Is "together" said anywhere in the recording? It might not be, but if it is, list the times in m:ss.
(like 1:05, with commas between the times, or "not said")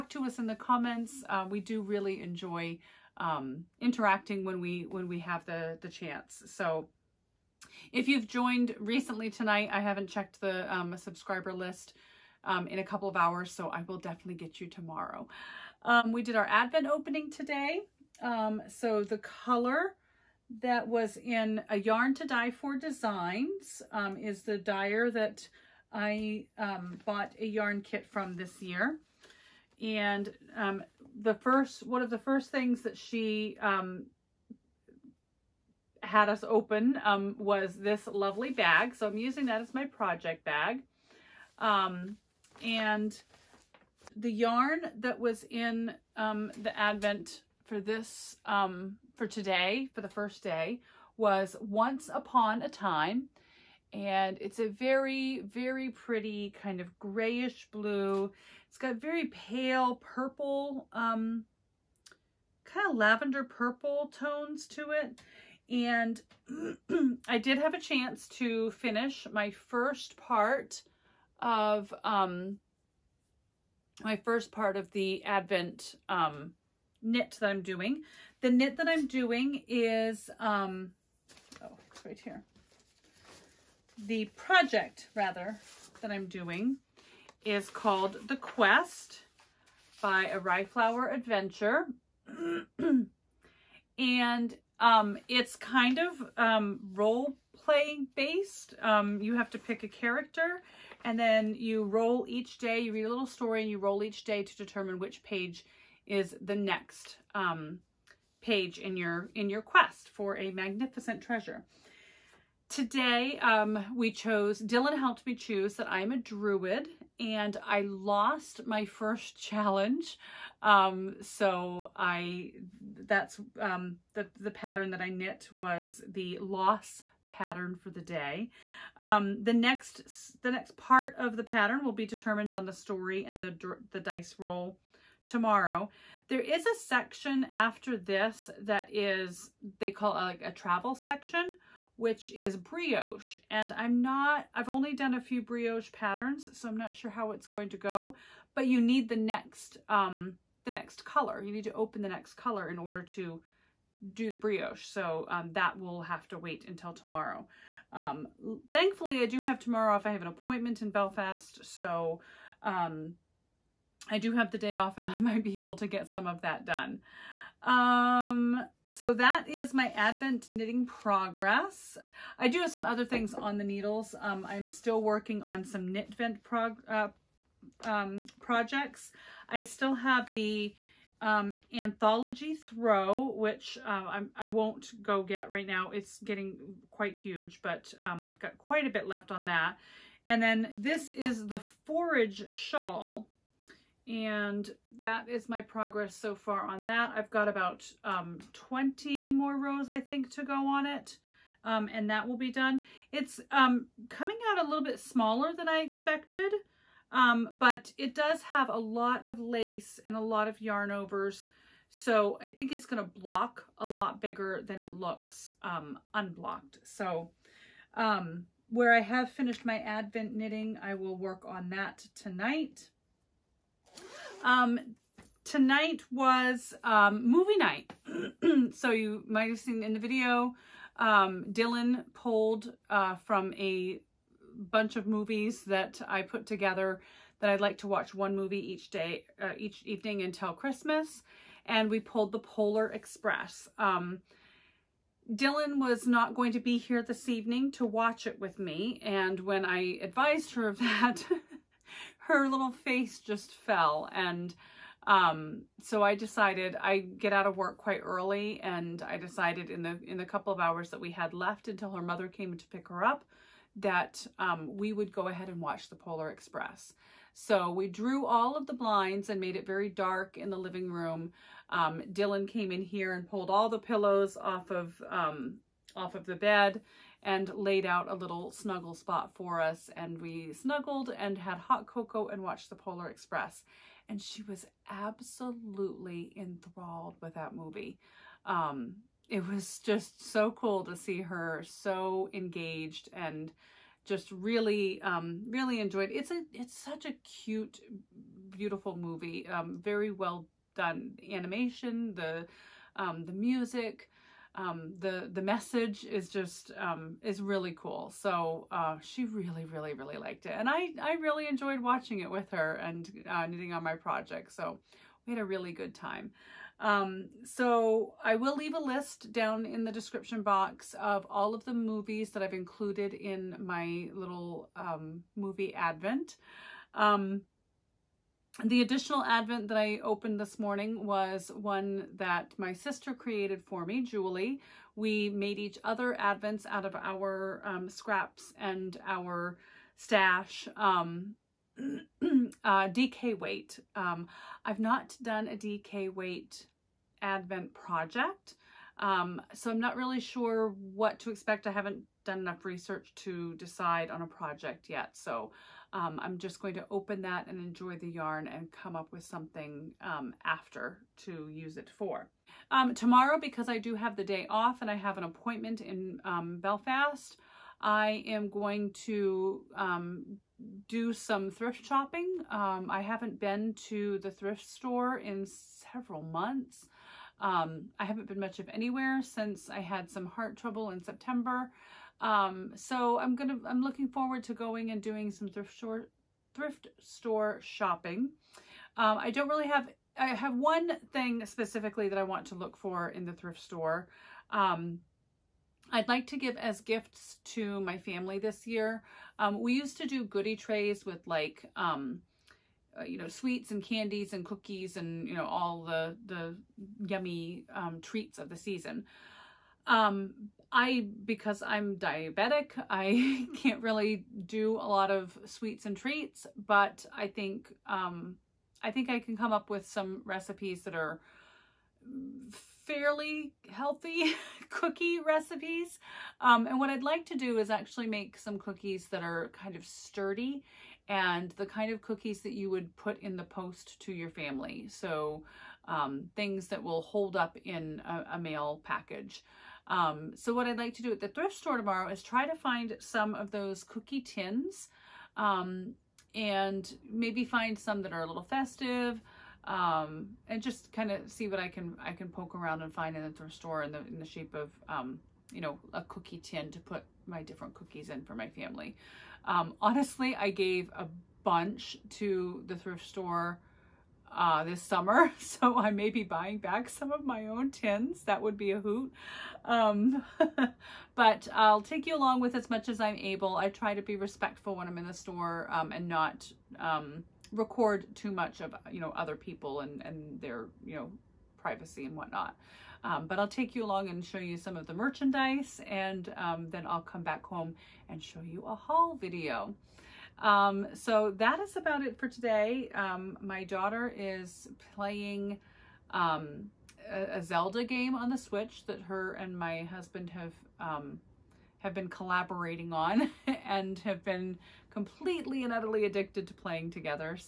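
3:56, 8:26.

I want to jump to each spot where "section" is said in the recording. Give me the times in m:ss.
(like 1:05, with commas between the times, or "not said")
2:16, 2:20.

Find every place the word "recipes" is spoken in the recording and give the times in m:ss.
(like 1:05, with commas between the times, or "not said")
7:00, 7:05.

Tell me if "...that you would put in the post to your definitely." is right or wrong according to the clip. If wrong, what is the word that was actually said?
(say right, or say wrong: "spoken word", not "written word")
wrong: "family", not "definitely".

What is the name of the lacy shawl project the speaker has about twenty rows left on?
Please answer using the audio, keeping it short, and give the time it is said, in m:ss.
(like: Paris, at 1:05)
Forage shawl, at 3:11.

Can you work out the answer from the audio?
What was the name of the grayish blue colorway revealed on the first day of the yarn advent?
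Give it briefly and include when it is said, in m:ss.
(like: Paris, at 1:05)
Once Upon a Time, at 0:51.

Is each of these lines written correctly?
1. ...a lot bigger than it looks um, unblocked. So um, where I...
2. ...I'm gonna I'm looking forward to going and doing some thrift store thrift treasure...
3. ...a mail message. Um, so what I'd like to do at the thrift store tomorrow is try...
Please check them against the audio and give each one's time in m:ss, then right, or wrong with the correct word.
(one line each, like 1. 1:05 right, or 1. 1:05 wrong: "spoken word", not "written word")
1. 3:33 right
2. 6:23 wrong: "store", not "treasure"
3. 7:18 wrong: "package", not "message".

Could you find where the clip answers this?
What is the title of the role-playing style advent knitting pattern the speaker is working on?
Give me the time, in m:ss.
1:28.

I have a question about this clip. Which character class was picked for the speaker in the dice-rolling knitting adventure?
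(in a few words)
Druid.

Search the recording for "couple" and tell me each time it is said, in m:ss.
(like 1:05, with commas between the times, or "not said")
0:12, 4:20.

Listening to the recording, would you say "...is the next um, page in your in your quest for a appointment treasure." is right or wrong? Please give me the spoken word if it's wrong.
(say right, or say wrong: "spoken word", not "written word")
wrong: "magnificent", not "appointment".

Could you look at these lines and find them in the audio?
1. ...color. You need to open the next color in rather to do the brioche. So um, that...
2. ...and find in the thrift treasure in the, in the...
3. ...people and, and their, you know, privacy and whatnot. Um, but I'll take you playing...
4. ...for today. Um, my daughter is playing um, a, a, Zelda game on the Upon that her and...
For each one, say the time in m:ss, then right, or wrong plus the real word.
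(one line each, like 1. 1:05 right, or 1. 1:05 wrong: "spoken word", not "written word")
1. 2:31 wrong: "order", not "rather"
2. 7:32 wrong: "store", not "treasure"
3. 7:59 wrong: "along", not "playing"
4. 8:12 wrong: "Switch", not "Upon".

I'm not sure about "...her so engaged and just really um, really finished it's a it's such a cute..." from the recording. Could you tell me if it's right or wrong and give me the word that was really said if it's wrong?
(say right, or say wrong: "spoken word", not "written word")
wrong: "enjoyed", not "finished".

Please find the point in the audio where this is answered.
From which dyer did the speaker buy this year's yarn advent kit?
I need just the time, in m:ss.
0:21.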